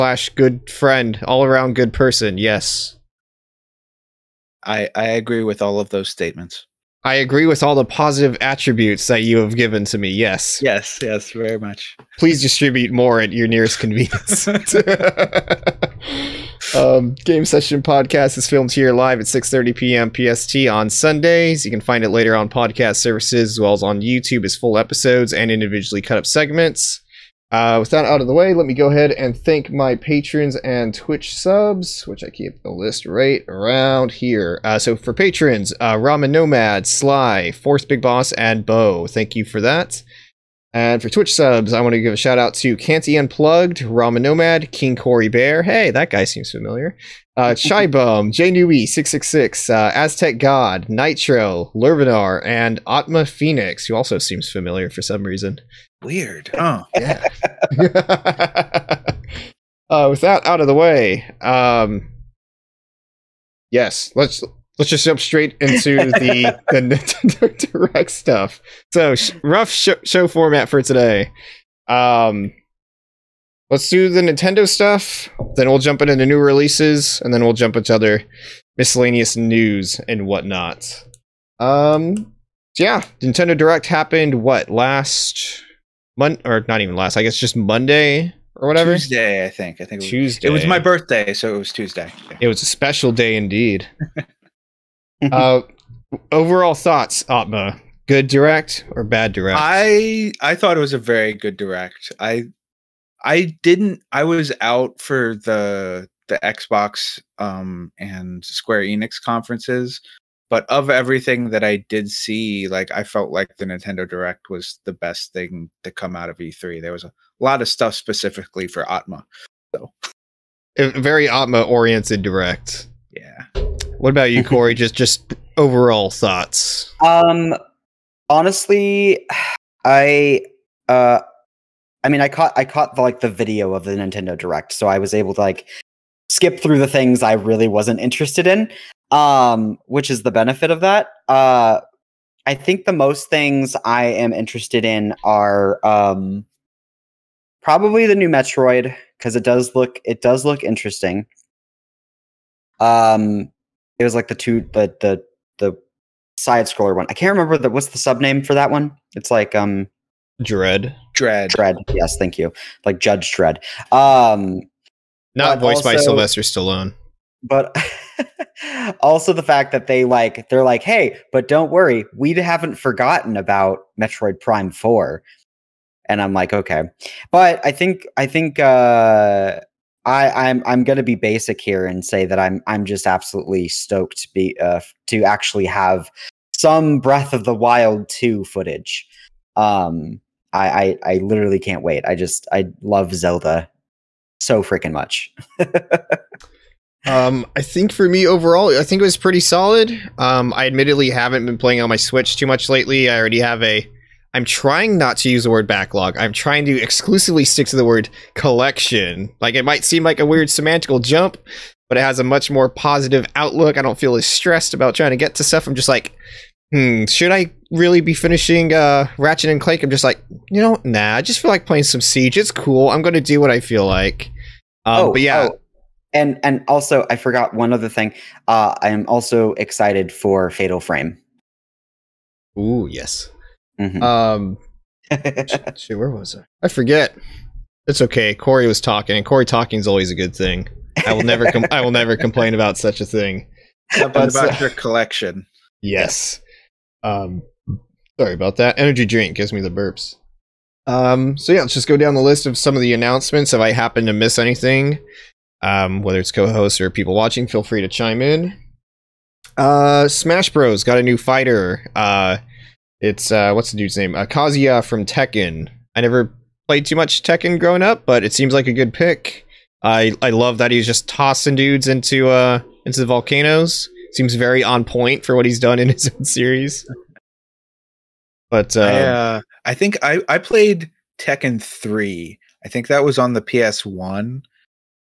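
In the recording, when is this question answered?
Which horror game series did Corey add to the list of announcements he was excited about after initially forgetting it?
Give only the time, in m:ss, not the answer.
3:50.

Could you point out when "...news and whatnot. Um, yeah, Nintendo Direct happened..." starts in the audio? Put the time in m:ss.
1:19.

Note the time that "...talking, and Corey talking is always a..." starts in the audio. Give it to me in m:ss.
3:58.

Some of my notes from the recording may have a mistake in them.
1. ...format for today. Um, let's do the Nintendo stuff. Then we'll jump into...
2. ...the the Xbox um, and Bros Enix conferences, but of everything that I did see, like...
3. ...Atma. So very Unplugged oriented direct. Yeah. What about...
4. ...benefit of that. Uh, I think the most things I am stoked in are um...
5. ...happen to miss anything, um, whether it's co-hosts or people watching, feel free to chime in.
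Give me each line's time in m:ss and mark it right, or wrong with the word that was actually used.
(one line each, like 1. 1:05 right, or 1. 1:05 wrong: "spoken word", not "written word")
1. 1:10 right
2. 1:45 wrong: "Square", not "Bros"
3. 1:58 wrong: "Atma", not "Unplugged"
4. 2:20 wrong: "interested", not "stoked"
5. 4:13 right.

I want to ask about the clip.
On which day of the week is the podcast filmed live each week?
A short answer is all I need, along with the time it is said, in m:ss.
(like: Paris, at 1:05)
Sundays, at 0:20.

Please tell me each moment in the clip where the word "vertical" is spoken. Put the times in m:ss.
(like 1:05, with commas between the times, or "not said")
not said.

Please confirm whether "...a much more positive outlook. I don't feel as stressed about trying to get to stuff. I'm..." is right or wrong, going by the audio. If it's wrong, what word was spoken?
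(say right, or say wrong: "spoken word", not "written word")
right.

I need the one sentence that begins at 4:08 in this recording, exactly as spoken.
Energy drink gives me the burps.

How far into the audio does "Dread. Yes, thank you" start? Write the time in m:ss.
2:41.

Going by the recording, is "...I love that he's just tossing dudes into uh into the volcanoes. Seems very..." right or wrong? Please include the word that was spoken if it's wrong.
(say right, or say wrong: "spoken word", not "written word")
right.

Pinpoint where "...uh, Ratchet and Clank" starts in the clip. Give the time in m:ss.
3:38.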